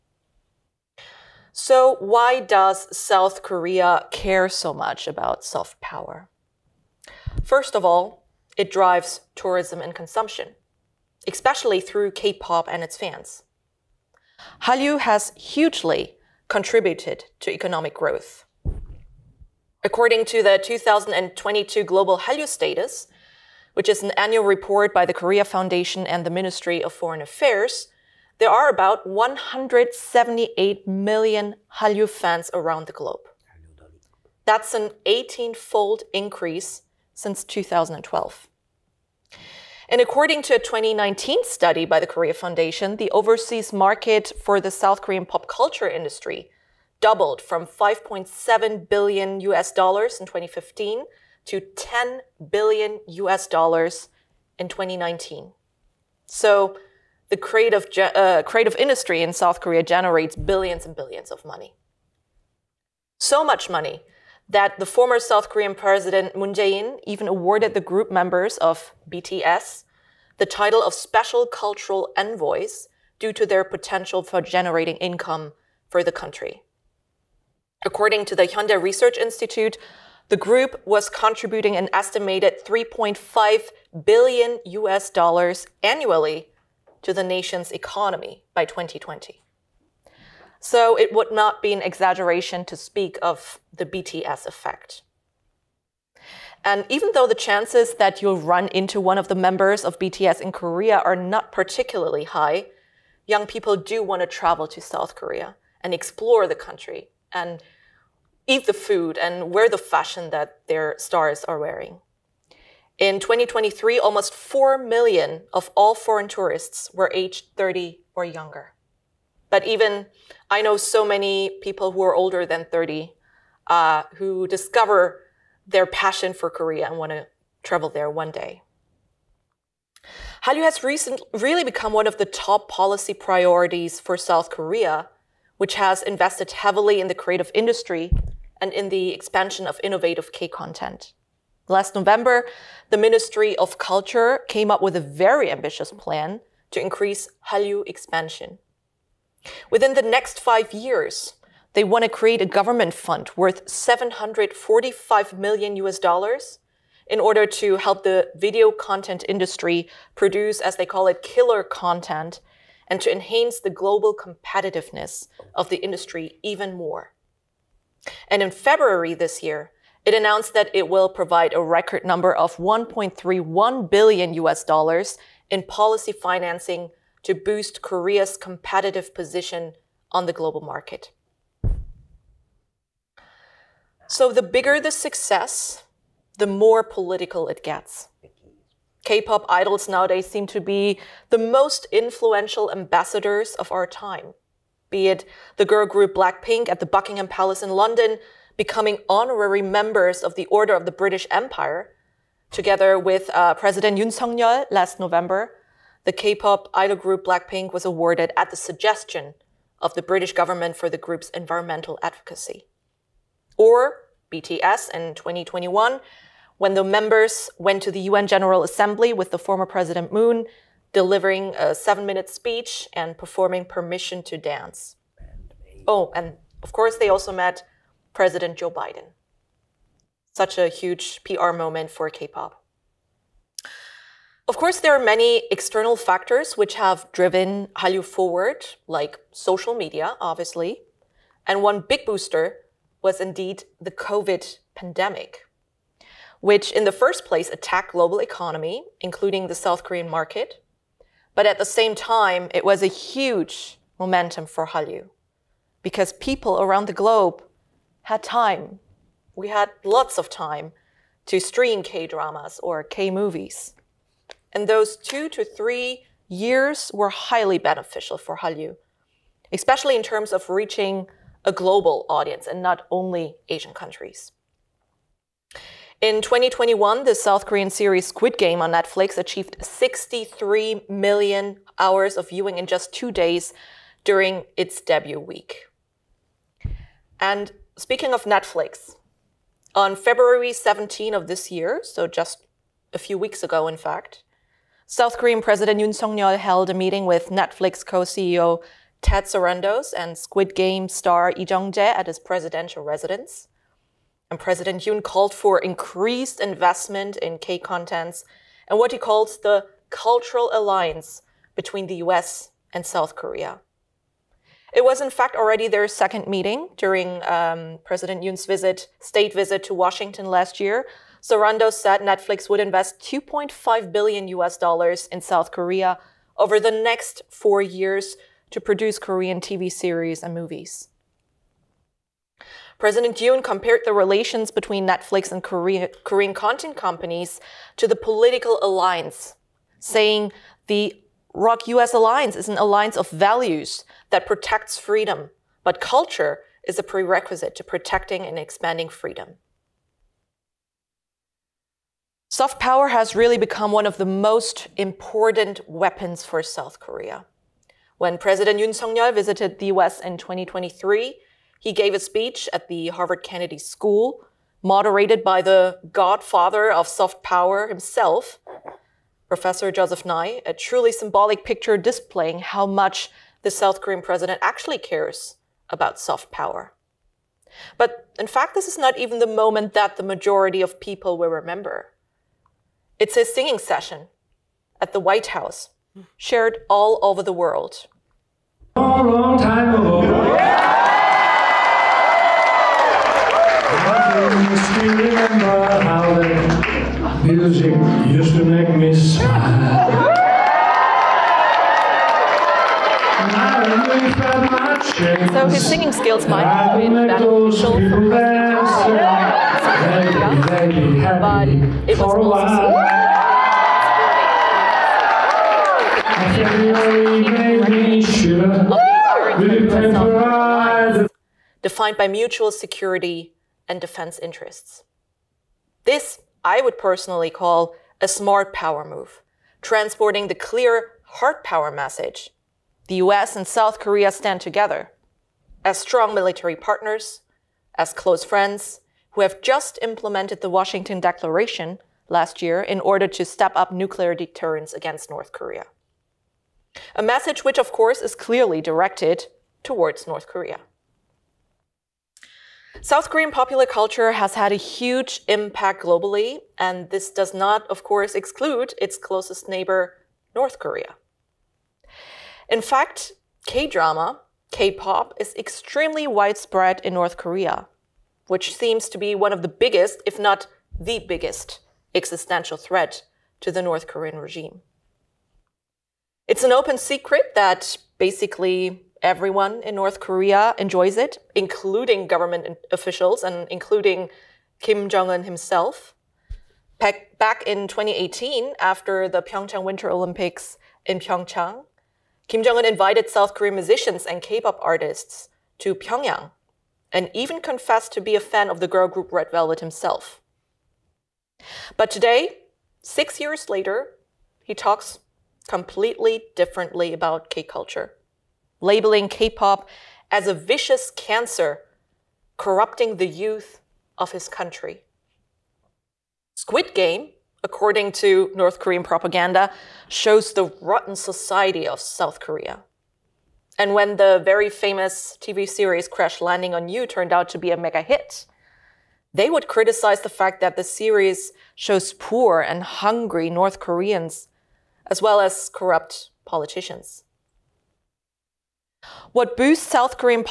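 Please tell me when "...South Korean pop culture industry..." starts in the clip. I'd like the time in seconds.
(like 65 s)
44 s.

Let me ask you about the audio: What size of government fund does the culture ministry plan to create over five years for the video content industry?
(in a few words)
745 million US dollars.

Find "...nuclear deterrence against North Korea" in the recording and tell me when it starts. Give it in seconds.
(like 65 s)
443 s.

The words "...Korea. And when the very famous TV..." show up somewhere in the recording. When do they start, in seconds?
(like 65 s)
522 s.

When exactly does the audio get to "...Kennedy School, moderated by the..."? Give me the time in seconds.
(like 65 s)
363 s.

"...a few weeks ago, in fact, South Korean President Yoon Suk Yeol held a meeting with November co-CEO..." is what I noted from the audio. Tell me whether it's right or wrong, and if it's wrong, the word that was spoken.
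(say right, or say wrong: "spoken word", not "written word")
wrong: "Netflix", not "November".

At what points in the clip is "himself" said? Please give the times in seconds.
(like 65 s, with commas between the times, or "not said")
367 s, 485 s, 499 s.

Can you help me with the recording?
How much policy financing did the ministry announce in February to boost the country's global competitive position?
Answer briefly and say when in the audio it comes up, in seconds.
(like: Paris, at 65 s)
1.31 billion US dollars, at 172 s.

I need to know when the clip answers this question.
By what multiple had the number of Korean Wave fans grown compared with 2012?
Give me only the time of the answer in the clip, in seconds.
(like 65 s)
35 s.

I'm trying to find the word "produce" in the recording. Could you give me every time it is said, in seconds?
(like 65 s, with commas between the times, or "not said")
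160 s, 328 s.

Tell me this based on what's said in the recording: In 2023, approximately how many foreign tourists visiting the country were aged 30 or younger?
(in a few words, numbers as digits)
almost 4 million.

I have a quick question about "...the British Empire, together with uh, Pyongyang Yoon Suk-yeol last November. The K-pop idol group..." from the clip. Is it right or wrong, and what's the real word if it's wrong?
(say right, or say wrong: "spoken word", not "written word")
wrong: "President", not "Pyongyang".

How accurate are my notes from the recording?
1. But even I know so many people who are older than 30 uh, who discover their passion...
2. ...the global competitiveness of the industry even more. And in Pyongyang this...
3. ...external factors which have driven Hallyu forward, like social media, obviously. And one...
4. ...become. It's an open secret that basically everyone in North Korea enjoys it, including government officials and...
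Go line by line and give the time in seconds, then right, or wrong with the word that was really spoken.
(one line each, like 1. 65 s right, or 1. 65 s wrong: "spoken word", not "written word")
1. 119 s right
2. 163 s wrong: "February", not "Pyongyang"
3. 235 s right
4. 474 s wrong: "regime", not "become".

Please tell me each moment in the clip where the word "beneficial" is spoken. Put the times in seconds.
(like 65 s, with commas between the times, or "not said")
267 s, 406 s.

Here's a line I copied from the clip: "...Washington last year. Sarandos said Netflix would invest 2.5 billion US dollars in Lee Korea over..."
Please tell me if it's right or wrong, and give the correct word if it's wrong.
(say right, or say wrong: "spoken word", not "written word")
wrong: "South", not "Lee".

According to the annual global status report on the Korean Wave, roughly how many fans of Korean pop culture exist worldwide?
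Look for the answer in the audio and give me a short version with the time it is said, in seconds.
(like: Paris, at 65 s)
178 million, at 29 s.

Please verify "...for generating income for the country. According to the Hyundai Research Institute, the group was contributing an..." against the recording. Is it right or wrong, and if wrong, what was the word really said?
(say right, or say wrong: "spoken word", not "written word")
right.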